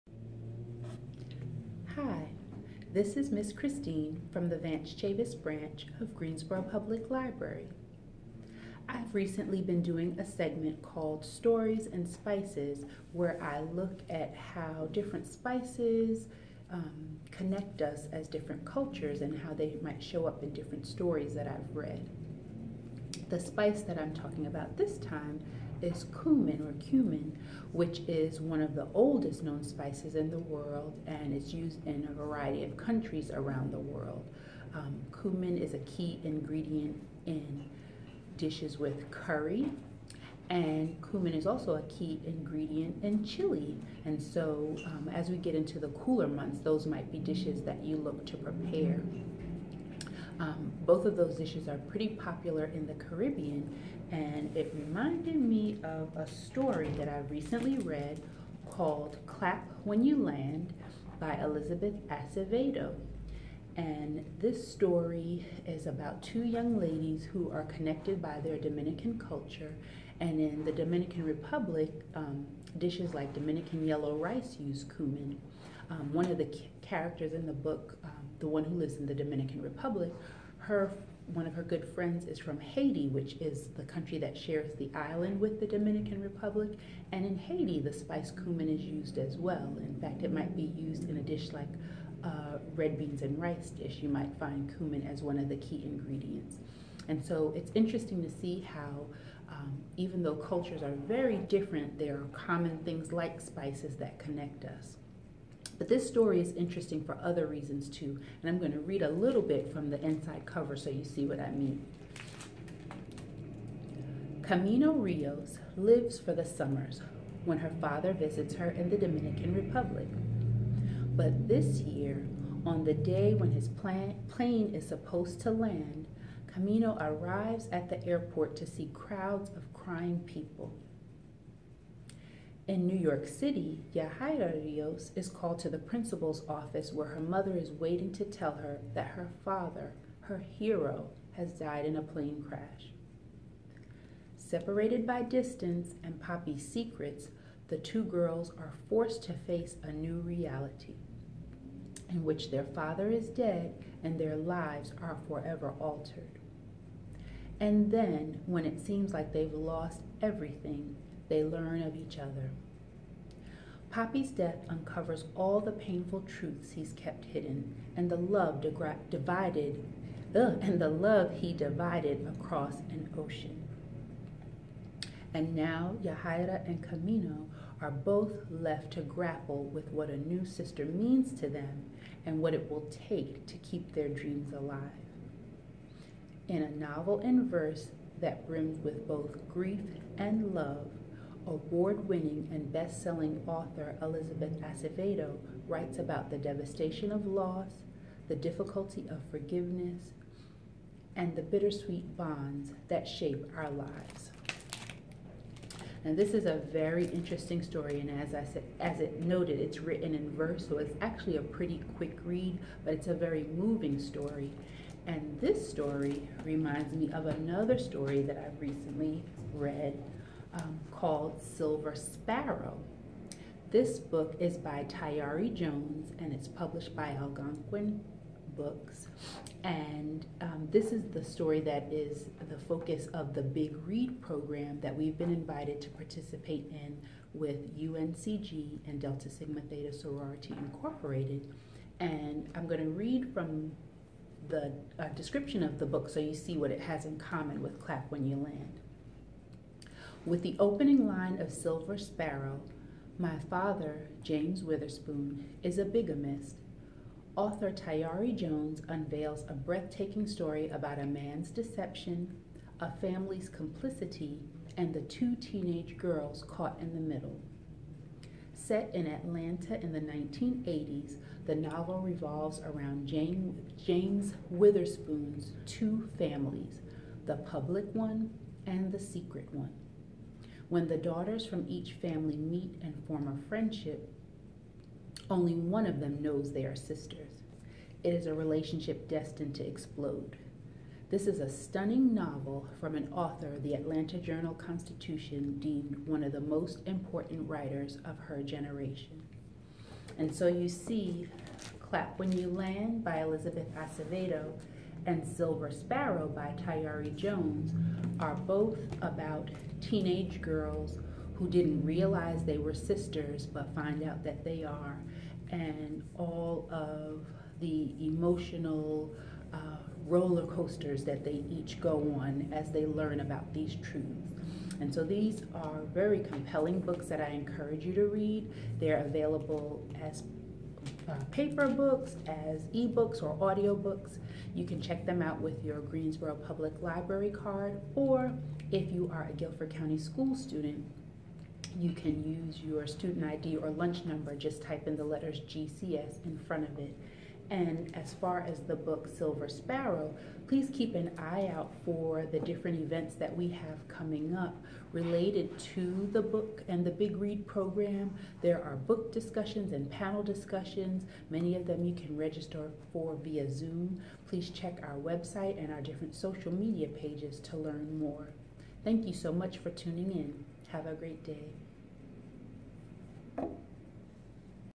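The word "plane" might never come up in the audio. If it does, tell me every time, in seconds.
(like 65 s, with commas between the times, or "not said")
123 s, 142 s.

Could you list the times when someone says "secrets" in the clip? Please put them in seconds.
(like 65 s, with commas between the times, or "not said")
146 s, 278 s.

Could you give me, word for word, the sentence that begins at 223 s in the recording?
This book is by Tayari Jones and it's published by Algonquin Books.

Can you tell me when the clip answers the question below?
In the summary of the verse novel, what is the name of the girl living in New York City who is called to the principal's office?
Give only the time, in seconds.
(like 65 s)
133 s.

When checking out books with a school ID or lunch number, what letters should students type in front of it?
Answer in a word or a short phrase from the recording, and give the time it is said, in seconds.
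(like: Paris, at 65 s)
GCS, at 345 s.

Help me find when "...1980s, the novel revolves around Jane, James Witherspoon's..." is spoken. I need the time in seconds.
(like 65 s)
270 s.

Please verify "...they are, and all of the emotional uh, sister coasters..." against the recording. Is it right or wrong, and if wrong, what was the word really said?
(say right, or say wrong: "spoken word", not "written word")
wrong: "roller", not "sister".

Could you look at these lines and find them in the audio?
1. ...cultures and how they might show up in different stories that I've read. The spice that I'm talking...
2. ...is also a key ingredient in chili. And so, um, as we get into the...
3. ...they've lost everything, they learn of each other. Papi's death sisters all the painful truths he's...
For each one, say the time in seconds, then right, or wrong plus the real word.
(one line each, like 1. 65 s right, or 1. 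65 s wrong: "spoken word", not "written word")
1. 18 s right
2. 41 s right
3. 159 s wrong: "uncovers", not "sisters".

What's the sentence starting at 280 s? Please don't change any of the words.
When the daughters from each family meet and form a friendship, only one of them knows they are sisters.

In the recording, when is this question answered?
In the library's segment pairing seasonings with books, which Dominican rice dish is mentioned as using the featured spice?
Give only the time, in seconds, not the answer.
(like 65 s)
73 s.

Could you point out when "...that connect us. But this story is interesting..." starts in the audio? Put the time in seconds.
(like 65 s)
103 s.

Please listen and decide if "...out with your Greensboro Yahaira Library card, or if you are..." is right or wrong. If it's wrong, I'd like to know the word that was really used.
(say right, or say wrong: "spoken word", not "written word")
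wrong: "Public", not "Yahaira".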